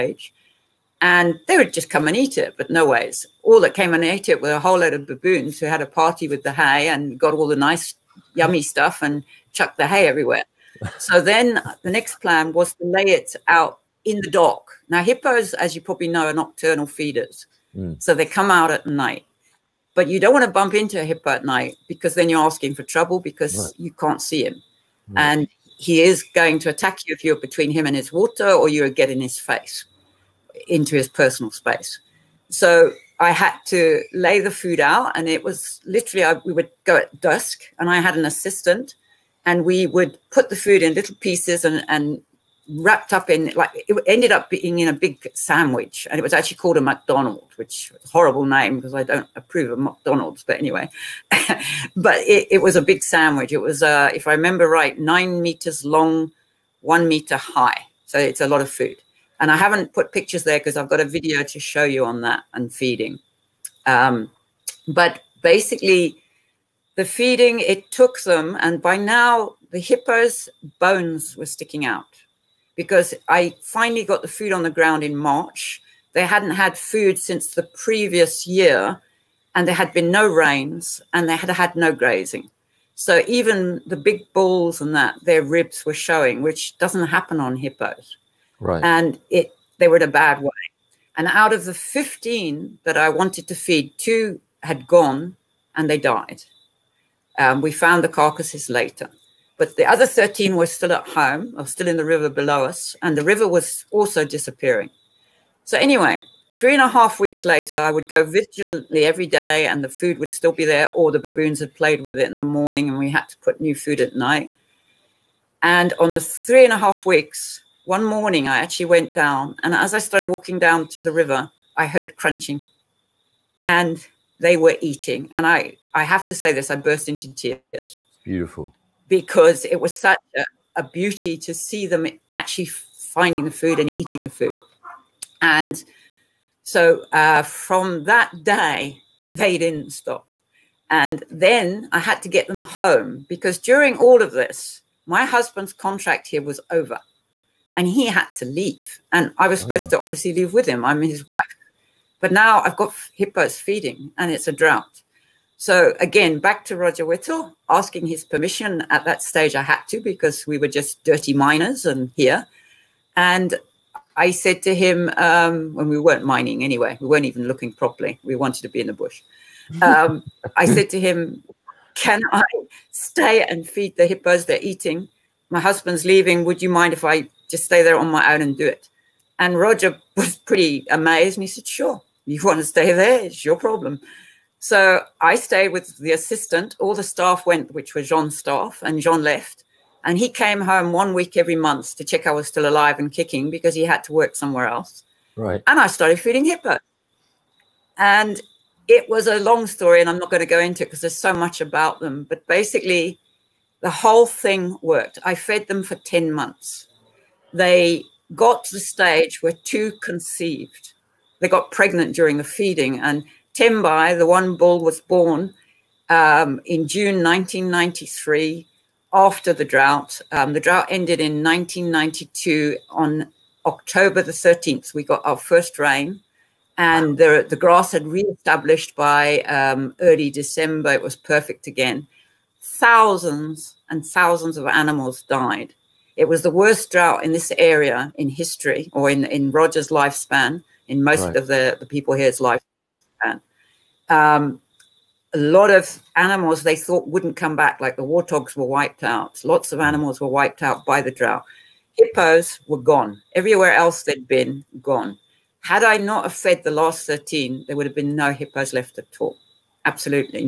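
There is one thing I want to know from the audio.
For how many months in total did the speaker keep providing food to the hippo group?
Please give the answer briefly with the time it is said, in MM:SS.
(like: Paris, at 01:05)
10 months, at 03:25.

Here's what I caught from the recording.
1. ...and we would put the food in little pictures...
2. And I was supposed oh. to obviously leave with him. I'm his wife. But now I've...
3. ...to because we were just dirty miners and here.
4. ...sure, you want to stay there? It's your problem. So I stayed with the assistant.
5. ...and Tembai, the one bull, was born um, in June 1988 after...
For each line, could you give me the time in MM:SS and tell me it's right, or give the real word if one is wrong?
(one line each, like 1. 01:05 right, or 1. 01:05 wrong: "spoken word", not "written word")
1. 00:39 wrong: "pieces", not "pictures"
2. 02:29 right
3. 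02:39 right
4. 03:01 right
5. 03:32 wrong: "1993", not "1988".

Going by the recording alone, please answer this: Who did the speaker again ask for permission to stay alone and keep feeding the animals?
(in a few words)
Roger Whittall.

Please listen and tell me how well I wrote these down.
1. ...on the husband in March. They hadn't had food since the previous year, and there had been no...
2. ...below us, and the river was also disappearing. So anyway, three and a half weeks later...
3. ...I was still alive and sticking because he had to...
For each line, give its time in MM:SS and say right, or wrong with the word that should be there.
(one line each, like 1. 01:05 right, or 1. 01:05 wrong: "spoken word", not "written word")
1. 01:14 wrong: "ground", not "husband"
2. 01:42 right
3. 03:12 wrong: "kicking", not "sticking".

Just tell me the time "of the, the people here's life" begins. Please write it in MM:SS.
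04:01.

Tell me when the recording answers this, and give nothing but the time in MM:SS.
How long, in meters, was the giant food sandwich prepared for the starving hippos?
00:54.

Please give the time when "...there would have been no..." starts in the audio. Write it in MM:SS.
04:17.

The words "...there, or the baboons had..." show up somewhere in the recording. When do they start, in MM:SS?
01:50.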